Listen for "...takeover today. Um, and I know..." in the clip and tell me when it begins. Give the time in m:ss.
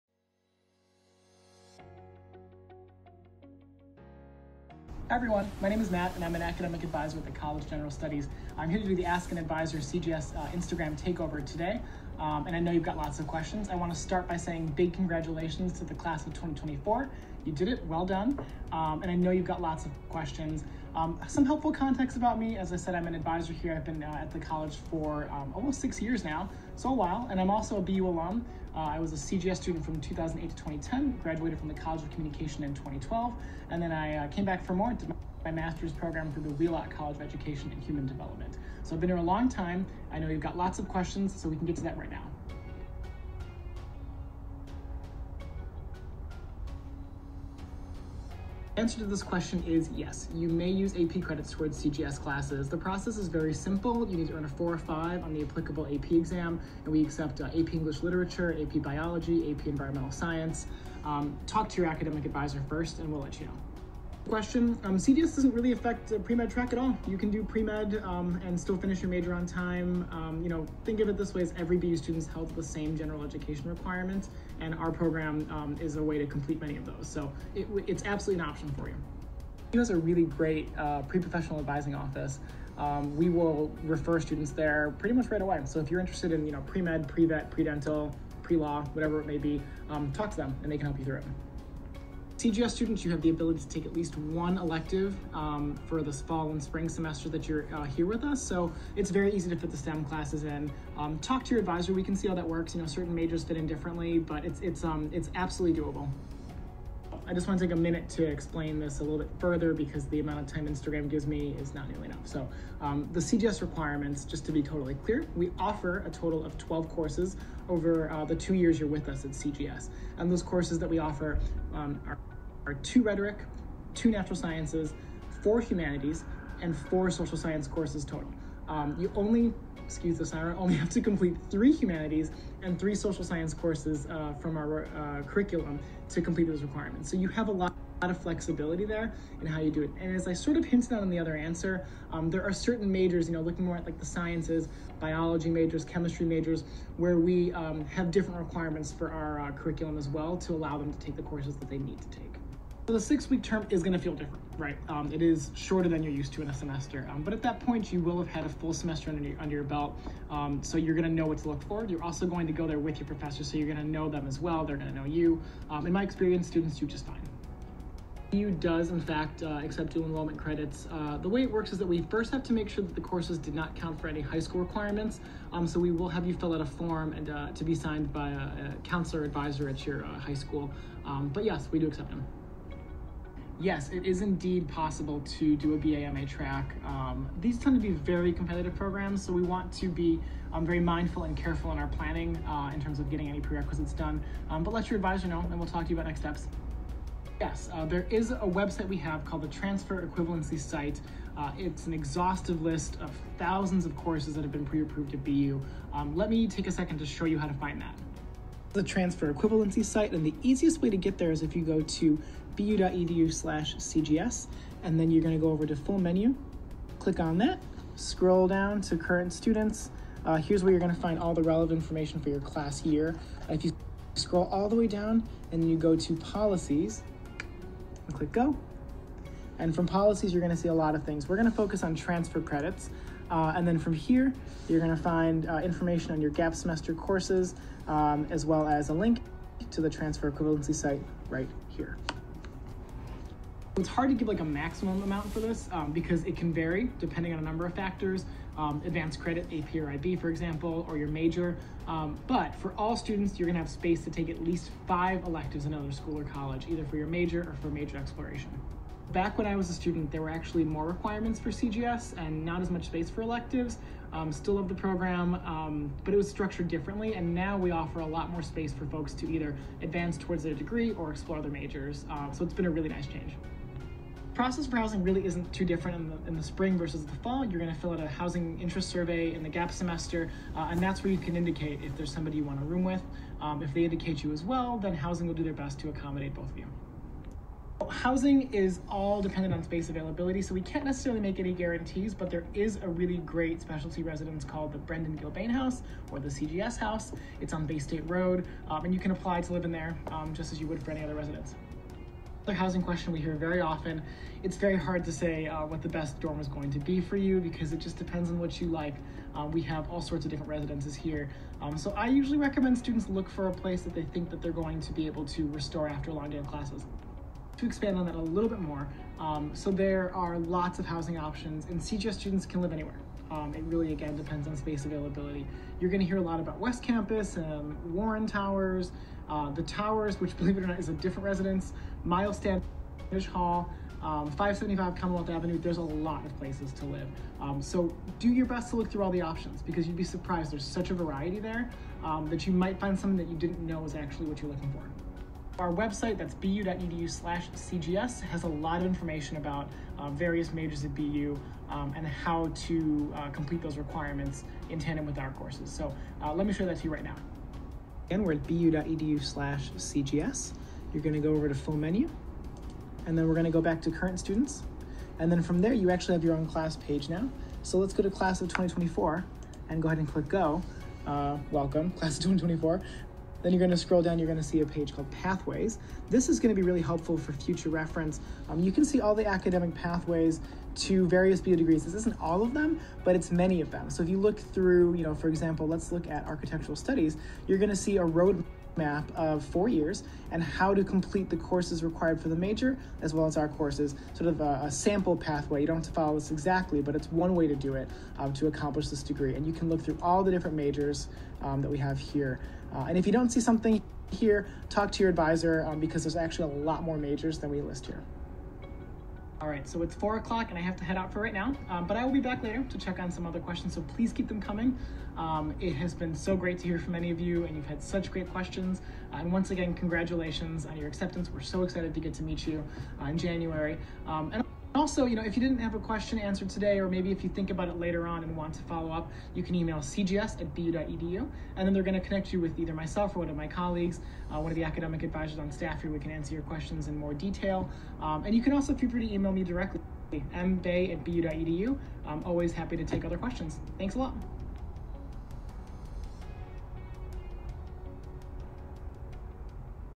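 0:10.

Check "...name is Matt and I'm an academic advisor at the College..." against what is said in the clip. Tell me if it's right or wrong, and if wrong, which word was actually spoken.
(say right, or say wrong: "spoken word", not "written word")
right.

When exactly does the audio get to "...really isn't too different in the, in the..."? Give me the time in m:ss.
4:35.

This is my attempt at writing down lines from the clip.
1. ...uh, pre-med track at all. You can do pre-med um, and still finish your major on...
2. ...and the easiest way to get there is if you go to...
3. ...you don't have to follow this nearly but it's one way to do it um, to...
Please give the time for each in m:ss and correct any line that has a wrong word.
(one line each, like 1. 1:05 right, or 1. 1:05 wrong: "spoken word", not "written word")
1. 1:06 right
2. 3:30 right
3. 6:35 wrong: "exactly", not "nearly".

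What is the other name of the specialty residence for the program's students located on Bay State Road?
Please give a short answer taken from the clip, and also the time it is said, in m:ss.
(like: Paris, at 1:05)
Brendan Gilbane House, at 4:54.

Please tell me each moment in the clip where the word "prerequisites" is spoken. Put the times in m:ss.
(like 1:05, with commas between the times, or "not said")
3:13.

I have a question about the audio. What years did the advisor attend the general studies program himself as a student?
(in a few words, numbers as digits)
2008 to 2010.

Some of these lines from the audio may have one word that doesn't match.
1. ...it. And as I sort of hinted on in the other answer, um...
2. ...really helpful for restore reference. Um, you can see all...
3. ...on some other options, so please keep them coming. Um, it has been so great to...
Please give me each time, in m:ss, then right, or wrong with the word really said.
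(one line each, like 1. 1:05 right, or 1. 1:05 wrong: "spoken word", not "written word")
1. 2:19 right
2. 6:16 wrong: "future", not "restore"
3. 6:52 wrong: "questions", not "options".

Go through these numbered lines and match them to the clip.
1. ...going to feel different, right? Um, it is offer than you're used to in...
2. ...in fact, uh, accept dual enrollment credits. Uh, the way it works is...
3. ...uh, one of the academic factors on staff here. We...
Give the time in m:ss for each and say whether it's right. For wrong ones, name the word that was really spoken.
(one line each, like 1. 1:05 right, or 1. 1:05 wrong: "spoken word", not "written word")
1. 2:33 wrong: "shorter", not "offer"
2. 2:48 right
3. 7:14 wrong: "advisors", not "factors".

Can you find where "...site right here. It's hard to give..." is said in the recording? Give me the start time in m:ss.
4:00.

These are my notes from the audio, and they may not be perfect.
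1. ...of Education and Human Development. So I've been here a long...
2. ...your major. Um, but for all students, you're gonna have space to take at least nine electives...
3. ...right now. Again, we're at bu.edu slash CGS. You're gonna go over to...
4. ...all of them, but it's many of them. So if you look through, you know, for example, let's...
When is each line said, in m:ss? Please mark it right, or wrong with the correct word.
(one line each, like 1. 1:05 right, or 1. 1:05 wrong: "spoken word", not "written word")
1. 0:37 right
2. 4:10 wrong: "five", not "nine"
3. 5:56 right
4. 6:22 right.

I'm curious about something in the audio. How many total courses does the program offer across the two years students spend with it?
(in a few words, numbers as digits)
12.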